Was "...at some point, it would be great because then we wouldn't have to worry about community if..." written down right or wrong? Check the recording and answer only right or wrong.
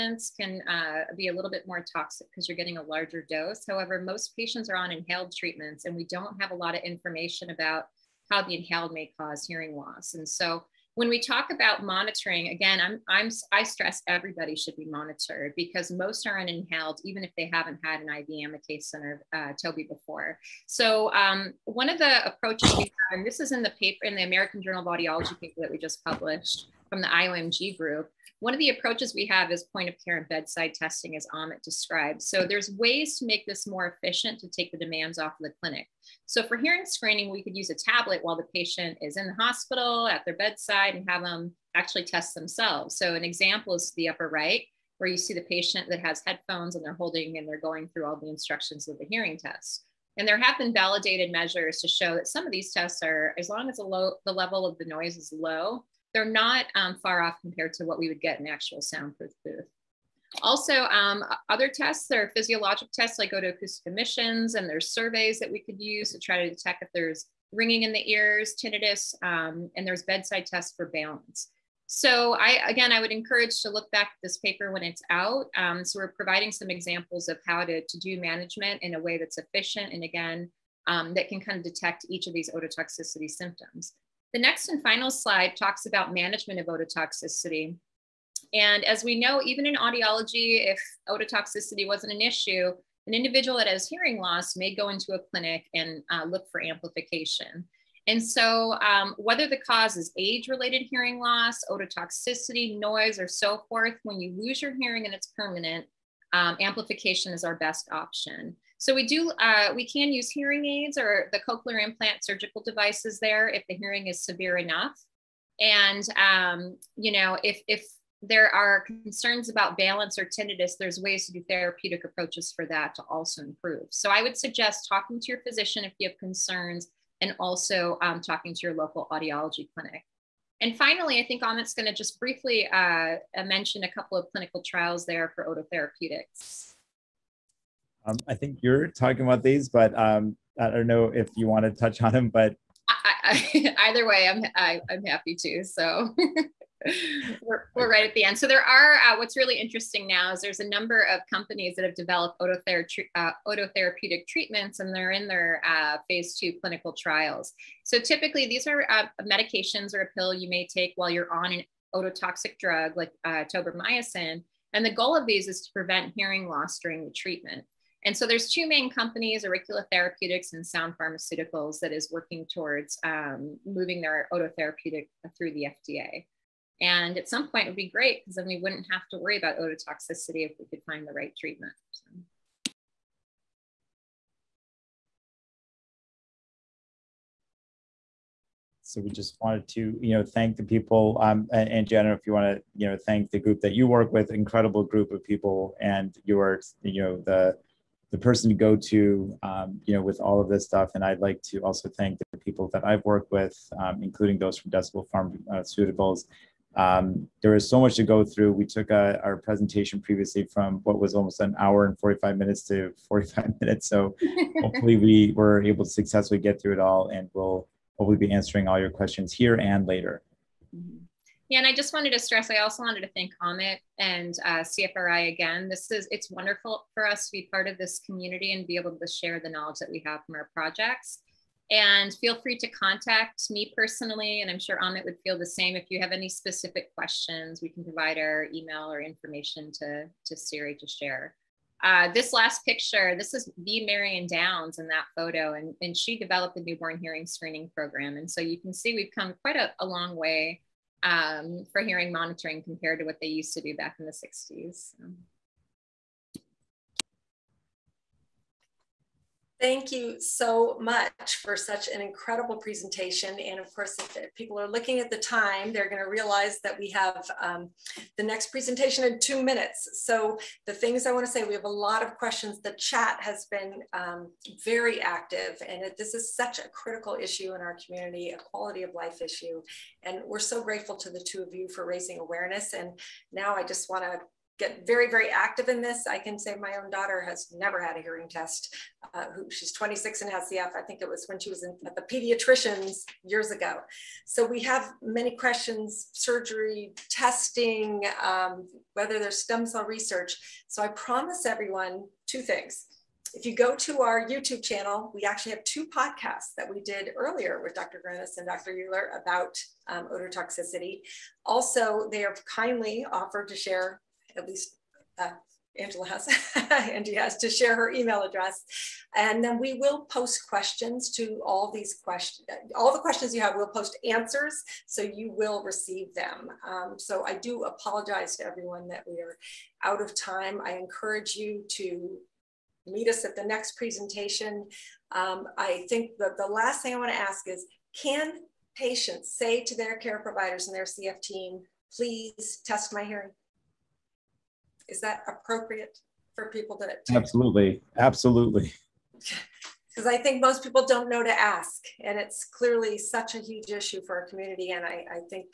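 wrong.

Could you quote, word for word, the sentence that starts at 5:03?
If you go to our YouTube channel, we actually have two podcasts that we did earlier with Dr.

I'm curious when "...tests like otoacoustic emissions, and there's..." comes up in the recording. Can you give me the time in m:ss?
1:02.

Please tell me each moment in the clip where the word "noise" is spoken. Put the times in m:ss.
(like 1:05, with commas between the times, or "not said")
0:54, 1:42.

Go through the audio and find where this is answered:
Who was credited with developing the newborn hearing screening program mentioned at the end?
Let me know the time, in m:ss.
4:03.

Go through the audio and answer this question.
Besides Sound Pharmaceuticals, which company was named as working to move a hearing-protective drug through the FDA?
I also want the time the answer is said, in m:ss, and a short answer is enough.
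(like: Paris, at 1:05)
Oricula Therapeutics, at 2:49.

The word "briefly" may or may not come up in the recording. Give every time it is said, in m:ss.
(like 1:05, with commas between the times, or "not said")
2:12.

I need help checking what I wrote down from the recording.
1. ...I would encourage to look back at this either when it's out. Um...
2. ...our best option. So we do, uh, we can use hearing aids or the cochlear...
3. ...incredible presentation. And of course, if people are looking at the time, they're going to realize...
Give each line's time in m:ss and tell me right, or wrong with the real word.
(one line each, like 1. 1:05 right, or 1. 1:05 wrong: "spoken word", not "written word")
1. 1:12 wrong: "paper", not "either"
2. 1:47 right
3. 4:21 right.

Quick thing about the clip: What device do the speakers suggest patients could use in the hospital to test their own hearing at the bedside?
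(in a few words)
A tablet.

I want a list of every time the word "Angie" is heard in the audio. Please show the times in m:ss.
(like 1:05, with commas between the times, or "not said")
5:16.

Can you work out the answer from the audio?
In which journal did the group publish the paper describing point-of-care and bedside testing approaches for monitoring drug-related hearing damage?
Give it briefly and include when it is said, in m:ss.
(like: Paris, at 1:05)
American Journal of Audiology, at 0:24.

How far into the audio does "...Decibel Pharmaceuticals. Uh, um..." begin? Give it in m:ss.
3:24.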